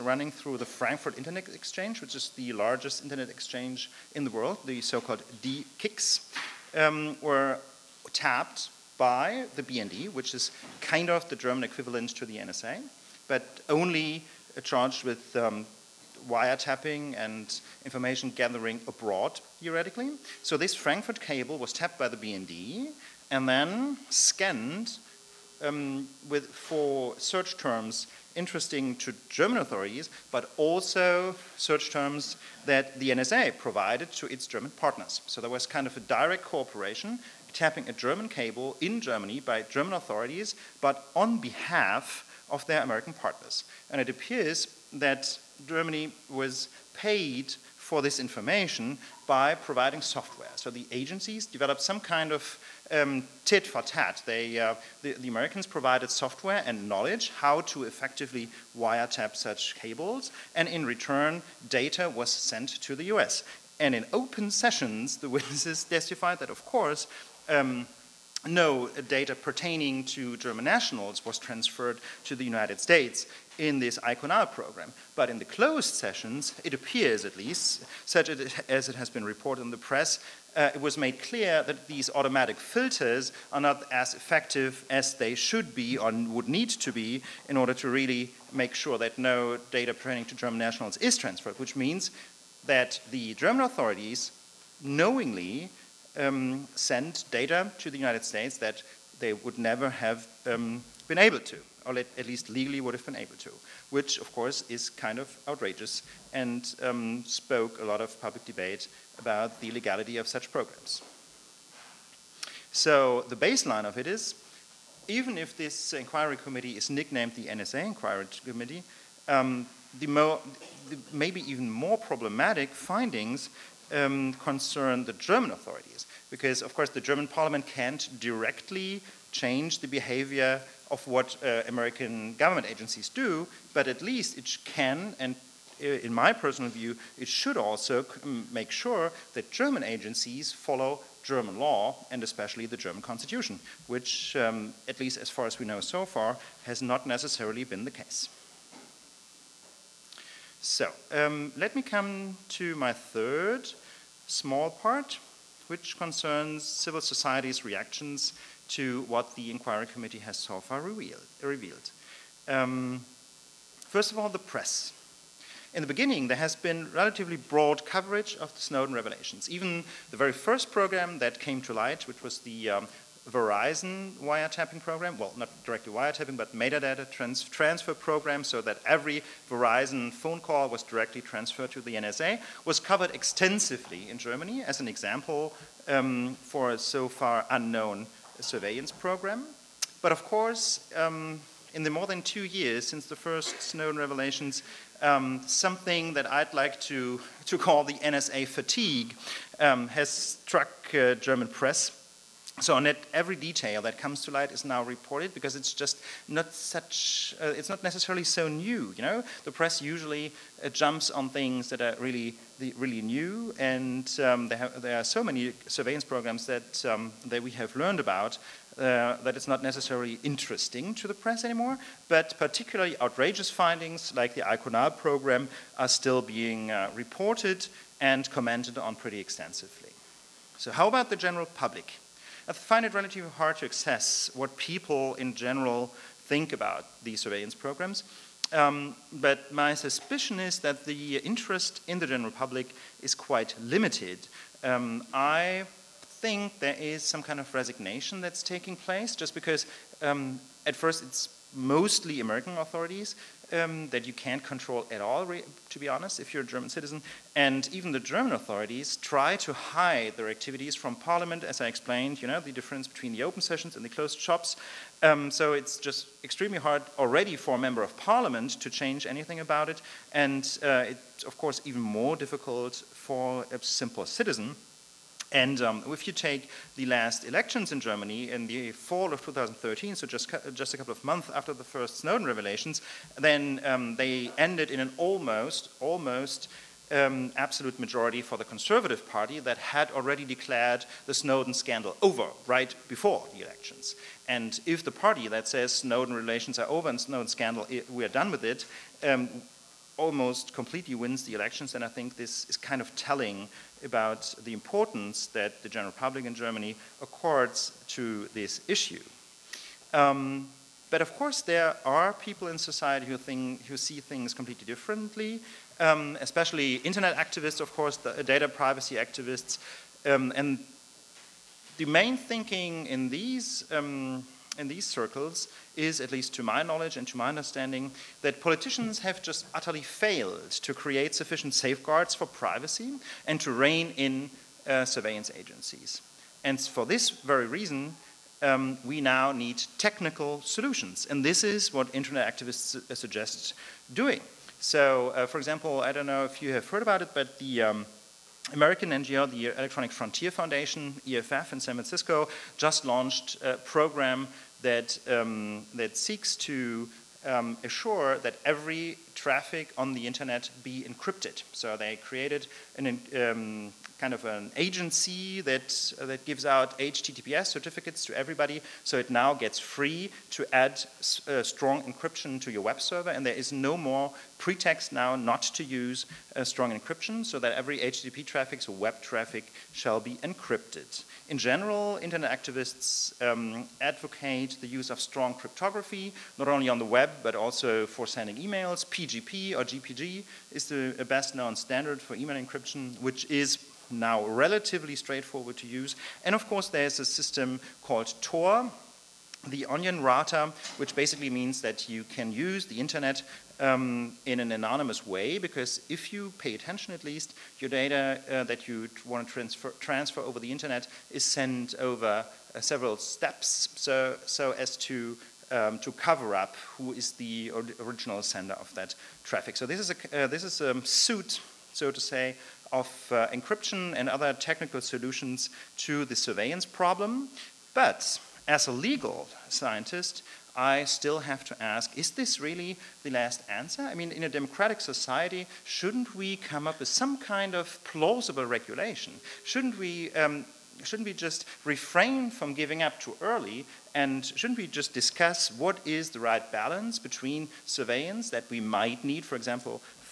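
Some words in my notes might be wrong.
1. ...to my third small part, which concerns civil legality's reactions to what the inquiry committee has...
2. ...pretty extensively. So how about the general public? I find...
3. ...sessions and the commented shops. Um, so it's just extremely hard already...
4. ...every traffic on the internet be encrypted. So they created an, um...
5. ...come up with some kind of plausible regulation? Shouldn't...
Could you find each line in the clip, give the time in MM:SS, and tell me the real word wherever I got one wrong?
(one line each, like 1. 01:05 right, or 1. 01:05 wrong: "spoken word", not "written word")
1. 02:32 wrong: "society", not "legality"
2. 03:48 right
3. 04:23 wrong: "closed", not "commented"
4. 05:58 right
5. 07:16 right.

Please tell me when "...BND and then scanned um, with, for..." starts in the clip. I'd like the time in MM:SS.
00:22.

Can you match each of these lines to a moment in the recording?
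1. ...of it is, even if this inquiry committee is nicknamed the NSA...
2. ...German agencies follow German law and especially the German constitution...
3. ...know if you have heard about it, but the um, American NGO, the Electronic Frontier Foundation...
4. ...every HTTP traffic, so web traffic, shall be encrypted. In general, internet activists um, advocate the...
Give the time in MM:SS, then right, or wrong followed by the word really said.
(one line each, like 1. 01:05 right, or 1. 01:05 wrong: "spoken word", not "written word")
1. 01:53 right
2. 02:19 right
3. 05:46 right
4. 06:17 right.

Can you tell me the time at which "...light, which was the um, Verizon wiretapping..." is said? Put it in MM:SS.
02:51.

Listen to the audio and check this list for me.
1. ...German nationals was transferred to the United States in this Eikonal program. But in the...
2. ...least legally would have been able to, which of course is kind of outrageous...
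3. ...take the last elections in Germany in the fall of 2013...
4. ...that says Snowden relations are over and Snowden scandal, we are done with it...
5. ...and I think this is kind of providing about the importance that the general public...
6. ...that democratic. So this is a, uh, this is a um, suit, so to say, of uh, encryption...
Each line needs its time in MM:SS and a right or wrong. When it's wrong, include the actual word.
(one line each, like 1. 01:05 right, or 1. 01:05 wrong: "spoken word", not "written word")
1. 01:10 right
2. 01:42 right
3. 04:36 right
4. 04:55 right
5. 05:01 wrong: "telling", not "providing"
6. 06:58 wrong: "traffic", not "democratic".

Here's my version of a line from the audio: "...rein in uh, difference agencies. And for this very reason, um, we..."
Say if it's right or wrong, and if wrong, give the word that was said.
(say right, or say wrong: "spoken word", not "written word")
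wrong: "surveillance", not "difference".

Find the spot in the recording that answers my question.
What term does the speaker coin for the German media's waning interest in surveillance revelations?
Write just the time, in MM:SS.
03:17.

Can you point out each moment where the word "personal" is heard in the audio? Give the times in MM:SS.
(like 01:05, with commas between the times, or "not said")
02:16.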